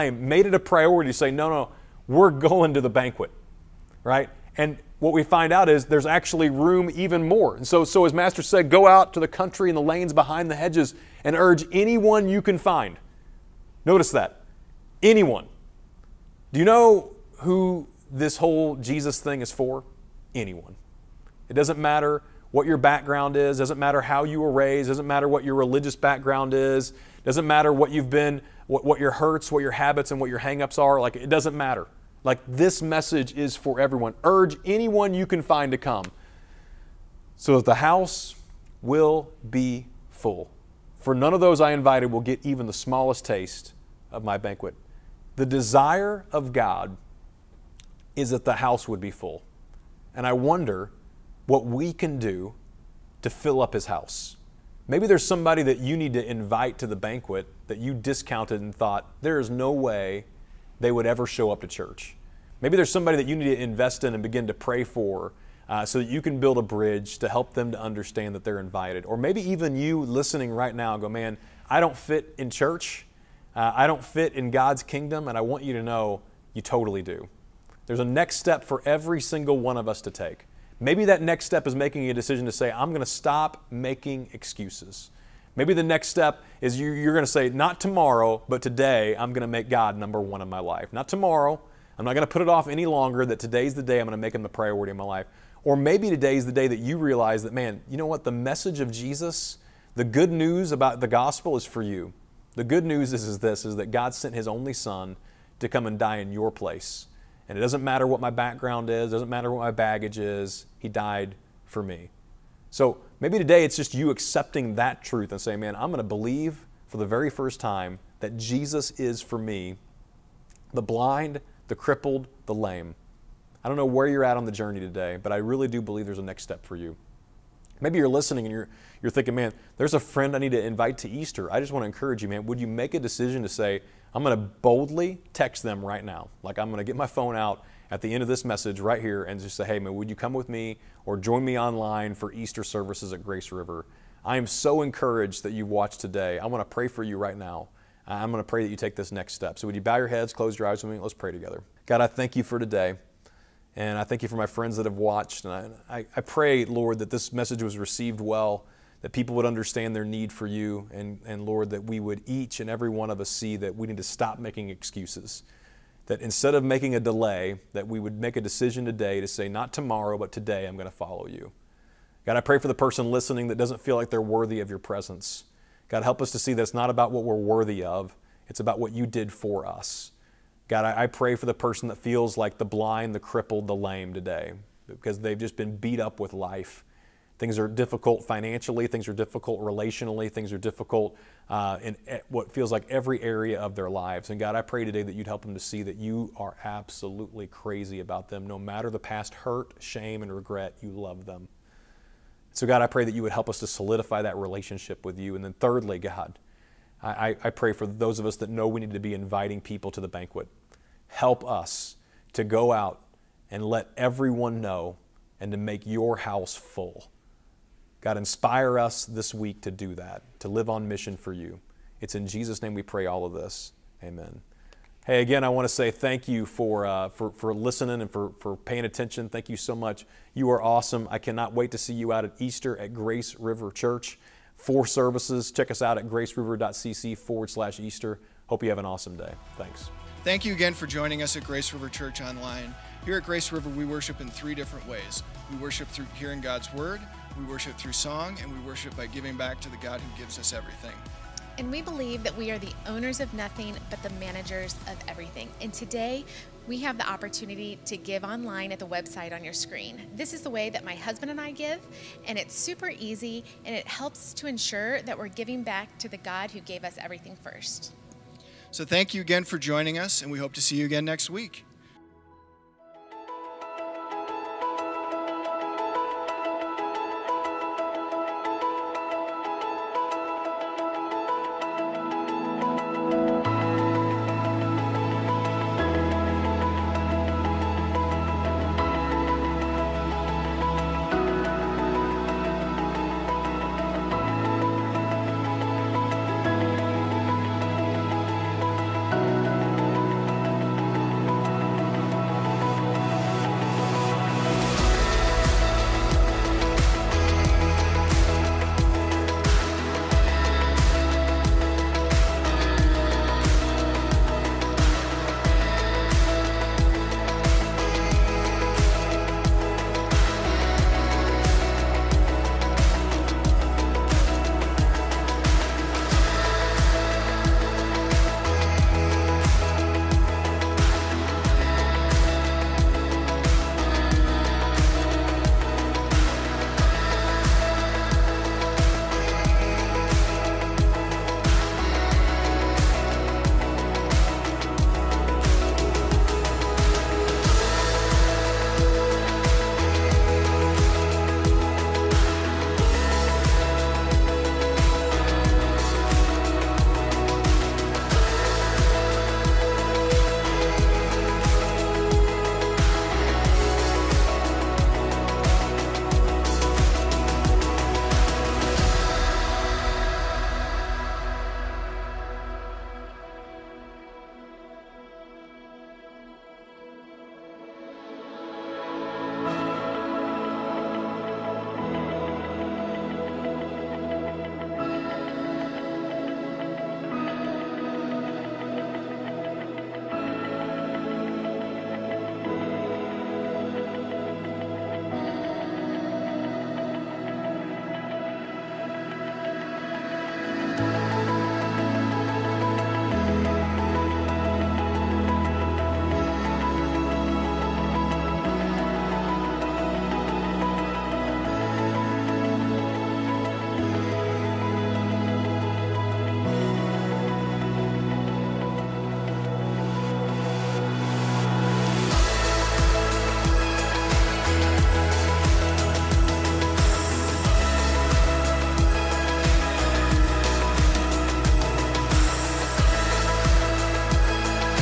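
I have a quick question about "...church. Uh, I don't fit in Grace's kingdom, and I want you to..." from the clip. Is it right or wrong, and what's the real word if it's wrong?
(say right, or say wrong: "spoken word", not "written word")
wrong: "God", not "Grace".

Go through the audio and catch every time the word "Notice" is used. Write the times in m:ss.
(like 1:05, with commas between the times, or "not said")
0:13.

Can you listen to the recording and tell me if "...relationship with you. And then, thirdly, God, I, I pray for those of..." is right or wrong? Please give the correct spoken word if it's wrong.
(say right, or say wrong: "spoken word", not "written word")
right.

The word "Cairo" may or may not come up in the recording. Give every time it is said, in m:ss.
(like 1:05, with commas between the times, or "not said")
not said.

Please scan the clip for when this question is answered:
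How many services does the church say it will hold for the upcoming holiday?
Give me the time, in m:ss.
3:54.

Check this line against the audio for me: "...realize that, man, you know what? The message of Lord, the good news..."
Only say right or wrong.
wrong.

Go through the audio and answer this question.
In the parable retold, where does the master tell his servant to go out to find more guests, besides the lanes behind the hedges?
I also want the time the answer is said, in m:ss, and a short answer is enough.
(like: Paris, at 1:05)
the country, at 0:09.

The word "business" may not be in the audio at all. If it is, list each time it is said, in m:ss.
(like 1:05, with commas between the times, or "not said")
not said.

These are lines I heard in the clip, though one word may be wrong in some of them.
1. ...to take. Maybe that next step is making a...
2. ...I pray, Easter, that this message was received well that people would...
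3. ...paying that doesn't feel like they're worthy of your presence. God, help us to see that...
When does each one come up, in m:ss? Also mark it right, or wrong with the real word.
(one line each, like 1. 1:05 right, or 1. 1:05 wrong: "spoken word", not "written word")
1. 1:20 right
2. 2:36 wrong: "Lord", not "Easter"
3. 2:53 wrong: "listening", not "paying".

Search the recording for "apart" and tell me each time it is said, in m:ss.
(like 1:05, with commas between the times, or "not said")
not said.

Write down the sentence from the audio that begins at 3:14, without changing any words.
And God, I pray today that you'd help them to see that you are absolutely crazy about them.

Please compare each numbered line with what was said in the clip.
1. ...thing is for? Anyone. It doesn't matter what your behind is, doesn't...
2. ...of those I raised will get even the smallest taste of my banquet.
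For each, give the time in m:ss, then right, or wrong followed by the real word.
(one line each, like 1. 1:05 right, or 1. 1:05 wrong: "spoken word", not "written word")
1. 0:19 wrong: "background", not "behind"
2. 0:41 wrong: "invited", not "raised".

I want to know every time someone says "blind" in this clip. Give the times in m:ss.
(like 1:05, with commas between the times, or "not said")
2:00, 3:02.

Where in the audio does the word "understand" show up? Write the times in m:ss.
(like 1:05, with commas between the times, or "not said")
1:07, 2:39.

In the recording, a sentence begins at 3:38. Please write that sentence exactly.
God, inspire us this week to do that, to live on mission for you.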